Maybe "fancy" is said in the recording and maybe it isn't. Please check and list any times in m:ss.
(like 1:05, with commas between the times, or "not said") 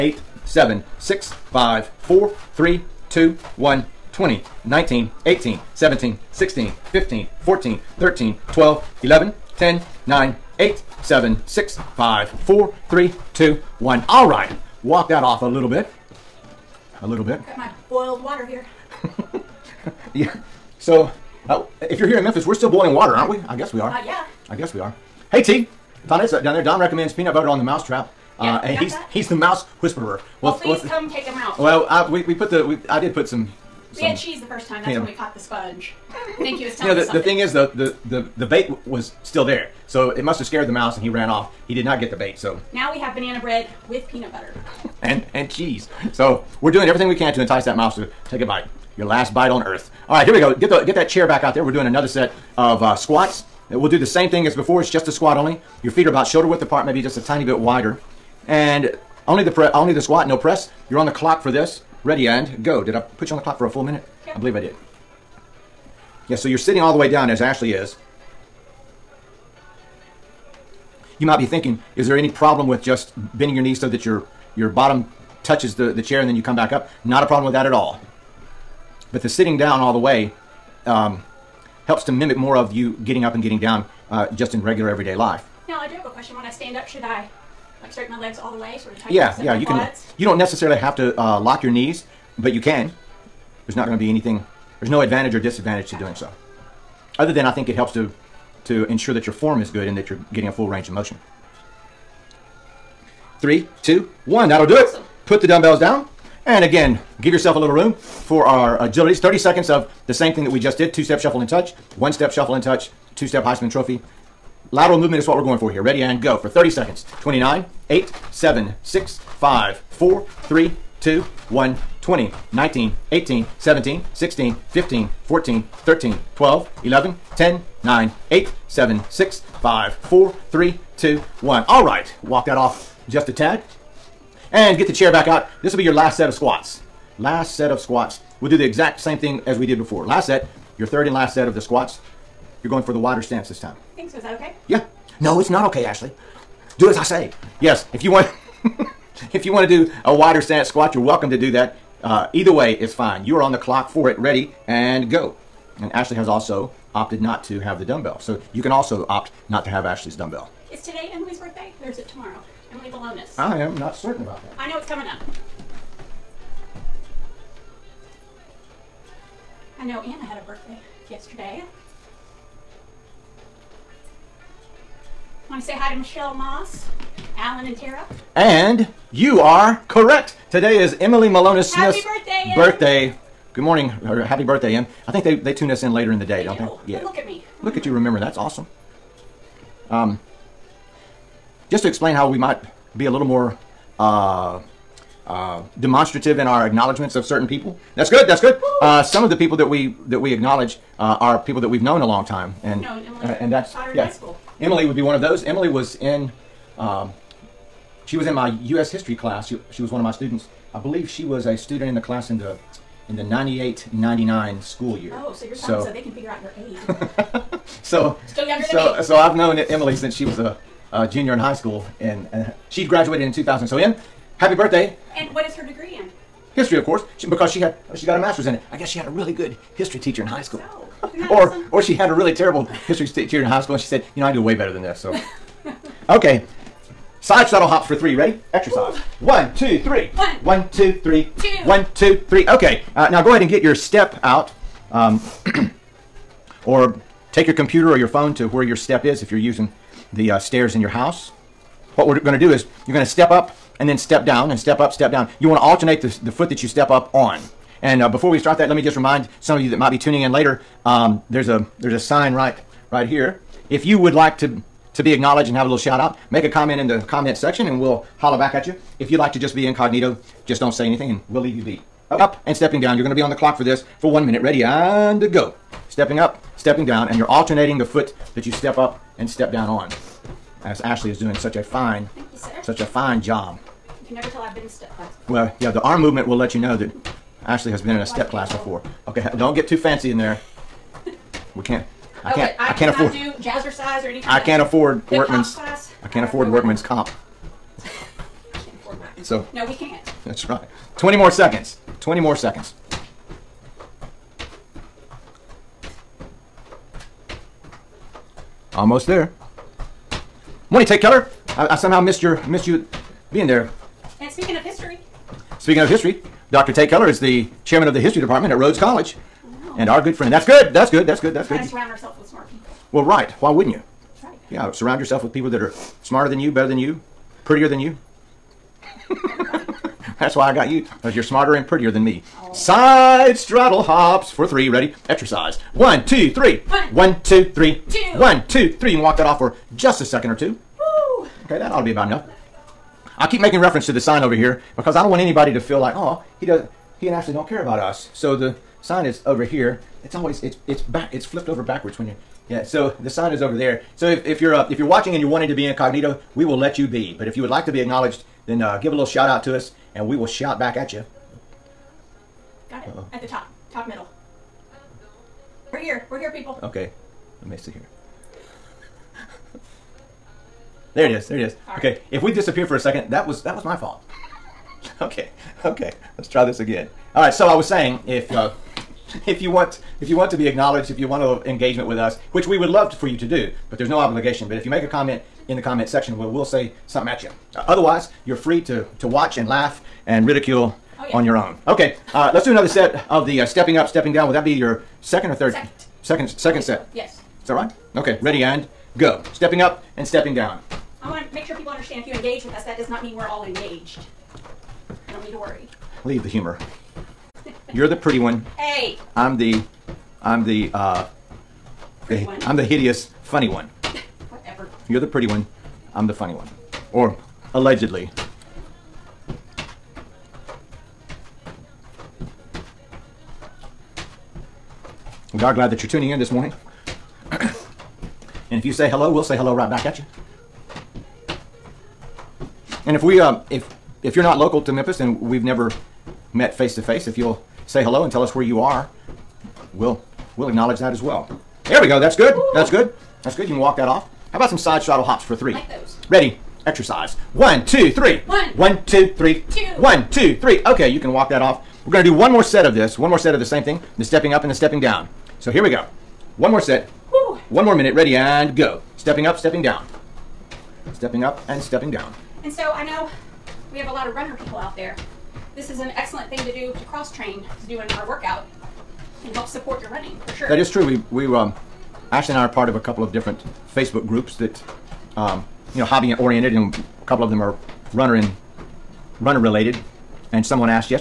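4:49.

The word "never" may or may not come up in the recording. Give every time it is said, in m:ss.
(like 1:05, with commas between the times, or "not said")
4:44, 7:15.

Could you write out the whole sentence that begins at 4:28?
If you'd like to just be incognito, just don't say anything and we'll leave you be up and stepping down.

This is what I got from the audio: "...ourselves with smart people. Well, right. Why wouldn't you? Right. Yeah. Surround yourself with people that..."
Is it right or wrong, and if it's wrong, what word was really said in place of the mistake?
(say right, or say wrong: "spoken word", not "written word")
right.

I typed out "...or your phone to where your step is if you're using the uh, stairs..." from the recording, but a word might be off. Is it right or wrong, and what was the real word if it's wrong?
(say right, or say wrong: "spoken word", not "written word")
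right.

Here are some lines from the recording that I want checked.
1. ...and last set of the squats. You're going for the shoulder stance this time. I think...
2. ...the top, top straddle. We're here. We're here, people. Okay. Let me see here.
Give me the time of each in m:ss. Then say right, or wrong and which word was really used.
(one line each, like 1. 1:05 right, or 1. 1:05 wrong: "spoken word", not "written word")
1. 2:21 wrong: "wider", not "shoulder"
2. 6:03 wrong: "middle", not "straddle".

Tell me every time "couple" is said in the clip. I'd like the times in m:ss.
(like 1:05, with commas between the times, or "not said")
7:52, 7:57.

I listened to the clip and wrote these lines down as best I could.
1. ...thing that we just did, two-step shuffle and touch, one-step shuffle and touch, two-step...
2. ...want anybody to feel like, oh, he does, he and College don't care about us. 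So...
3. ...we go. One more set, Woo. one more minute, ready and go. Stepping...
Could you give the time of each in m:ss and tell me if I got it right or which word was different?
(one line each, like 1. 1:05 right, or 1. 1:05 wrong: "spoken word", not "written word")
1. 1:50 right
2. 5:45 wrong: "Ashley", not "College"
3. 7:35 right.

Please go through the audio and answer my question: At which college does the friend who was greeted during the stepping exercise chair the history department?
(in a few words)
Rhodes College.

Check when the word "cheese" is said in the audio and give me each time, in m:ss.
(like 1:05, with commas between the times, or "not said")
0:34, 0:45.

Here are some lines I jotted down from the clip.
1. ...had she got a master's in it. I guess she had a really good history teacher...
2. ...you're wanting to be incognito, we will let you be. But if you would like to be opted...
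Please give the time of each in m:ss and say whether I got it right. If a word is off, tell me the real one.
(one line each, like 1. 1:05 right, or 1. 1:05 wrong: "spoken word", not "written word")
1. 3:47 right
2. 5:55 wrong: "acknowledged", not "opted".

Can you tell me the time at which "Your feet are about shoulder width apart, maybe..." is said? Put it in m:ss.
0:55.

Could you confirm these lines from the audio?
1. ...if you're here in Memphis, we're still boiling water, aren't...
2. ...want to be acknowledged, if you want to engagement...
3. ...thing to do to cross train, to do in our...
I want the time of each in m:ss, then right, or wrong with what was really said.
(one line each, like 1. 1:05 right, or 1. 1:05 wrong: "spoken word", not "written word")
1. 0:21 right
2. 6:20 right
3. 7:46 right.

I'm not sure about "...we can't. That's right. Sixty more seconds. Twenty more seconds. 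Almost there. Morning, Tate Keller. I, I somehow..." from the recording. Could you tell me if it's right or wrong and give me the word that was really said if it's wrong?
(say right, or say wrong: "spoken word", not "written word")
wrong: "Twenty", not "Sixty".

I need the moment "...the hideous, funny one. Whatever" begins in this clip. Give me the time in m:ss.
6:52.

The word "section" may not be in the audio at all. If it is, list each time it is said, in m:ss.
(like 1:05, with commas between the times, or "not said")
4:27, 6:25.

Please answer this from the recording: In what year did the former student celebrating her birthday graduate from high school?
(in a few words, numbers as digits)
2000.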